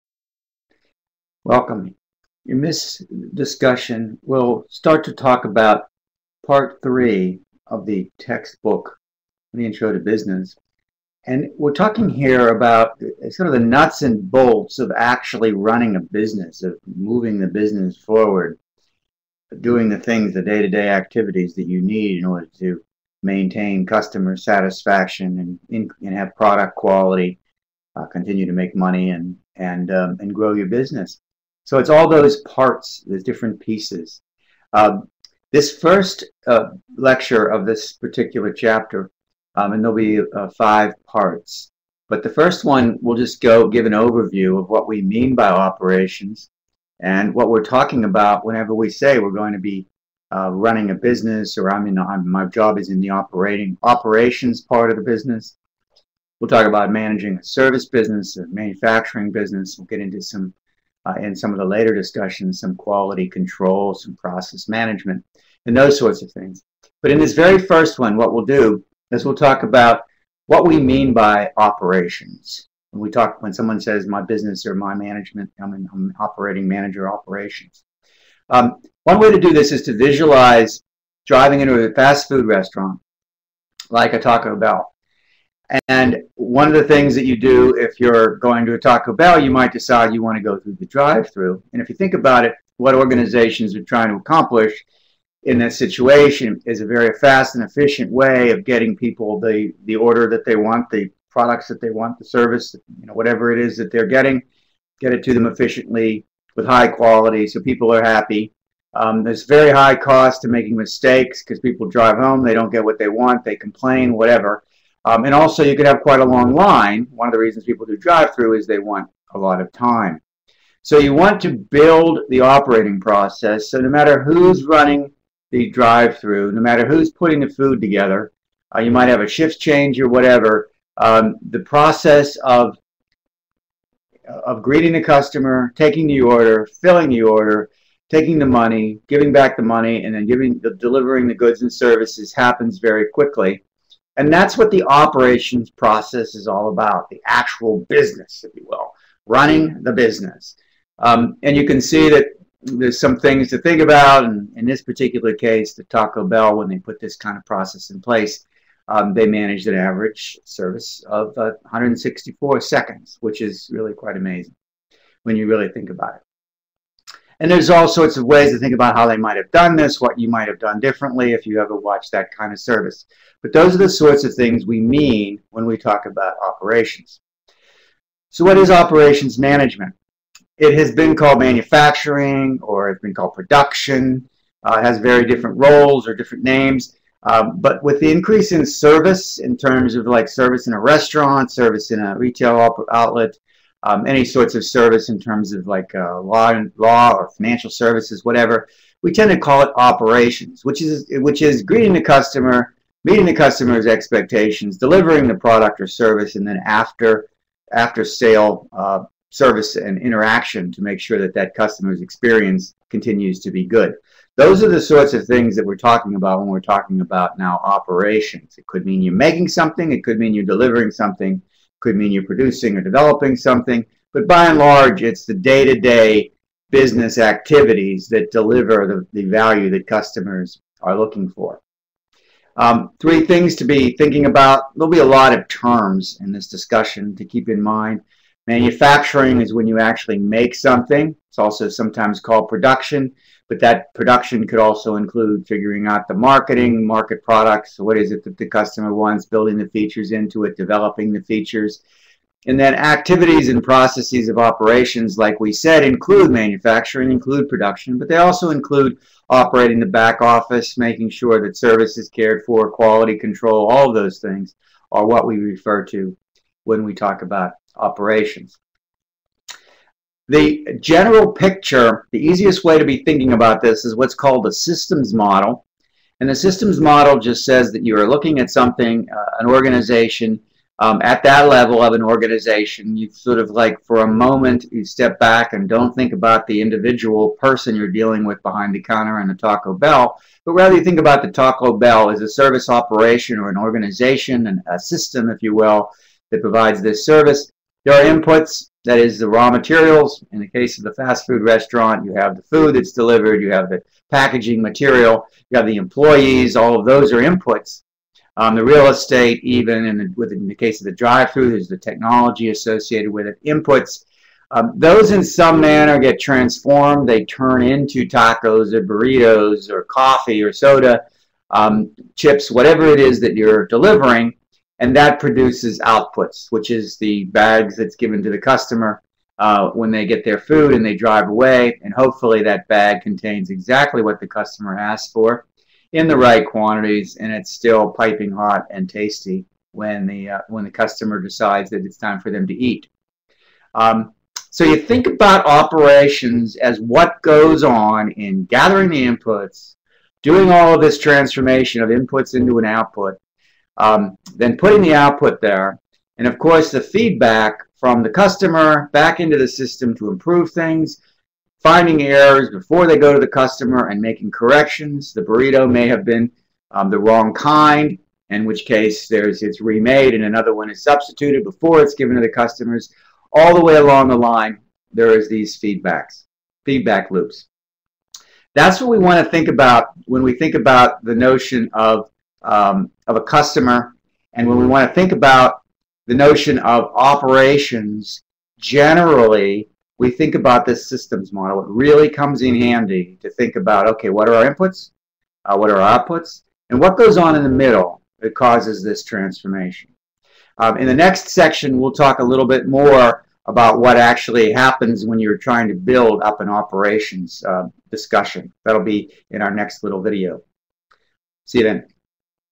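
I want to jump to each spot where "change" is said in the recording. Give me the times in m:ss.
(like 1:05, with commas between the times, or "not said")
2:09.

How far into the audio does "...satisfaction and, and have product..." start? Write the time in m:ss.
0:24.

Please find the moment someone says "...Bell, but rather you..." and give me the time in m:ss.
4:49.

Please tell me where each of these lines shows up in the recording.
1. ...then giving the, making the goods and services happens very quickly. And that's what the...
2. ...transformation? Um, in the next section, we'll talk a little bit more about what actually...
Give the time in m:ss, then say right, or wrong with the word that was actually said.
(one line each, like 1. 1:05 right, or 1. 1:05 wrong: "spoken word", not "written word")
1. 2:20 wrong: "delivering", not "making"
2. 6:39 right.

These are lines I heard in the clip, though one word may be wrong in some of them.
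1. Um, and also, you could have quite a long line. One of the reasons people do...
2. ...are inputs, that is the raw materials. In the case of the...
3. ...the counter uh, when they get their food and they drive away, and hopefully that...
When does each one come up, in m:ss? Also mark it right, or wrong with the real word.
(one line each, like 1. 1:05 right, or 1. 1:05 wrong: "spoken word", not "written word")
1. 1:55 right
2. 4:57 right
3. 5:28 wrong: "customer", not "counter".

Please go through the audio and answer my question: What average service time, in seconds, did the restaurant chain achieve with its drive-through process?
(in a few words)
164.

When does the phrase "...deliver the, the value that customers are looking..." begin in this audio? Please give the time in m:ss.
3:48.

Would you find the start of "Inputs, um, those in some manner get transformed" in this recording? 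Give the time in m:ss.
5:13.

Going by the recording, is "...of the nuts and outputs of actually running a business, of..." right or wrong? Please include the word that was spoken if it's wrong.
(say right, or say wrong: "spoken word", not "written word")
wrong: "bolts", not "outputs".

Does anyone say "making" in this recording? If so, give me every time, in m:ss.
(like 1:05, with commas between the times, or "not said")
1:50, 3:39, 4:20, 6:04.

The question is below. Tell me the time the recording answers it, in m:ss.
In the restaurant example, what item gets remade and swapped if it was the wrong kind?
6:05.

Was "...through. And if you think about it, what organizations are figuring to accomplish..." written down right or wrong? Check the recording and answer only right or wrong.
wrong.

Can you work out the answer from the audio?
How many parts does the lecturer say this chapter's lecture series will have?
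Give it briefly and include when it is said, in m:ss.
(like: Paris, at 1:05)
5, at 0:40.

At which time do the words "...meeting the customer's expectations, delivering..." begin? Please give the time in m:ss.
3:23.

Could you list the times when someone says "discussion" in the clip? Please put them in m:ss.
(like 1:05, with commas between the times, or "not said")
0:03, 1:01, 3:56, 6:47.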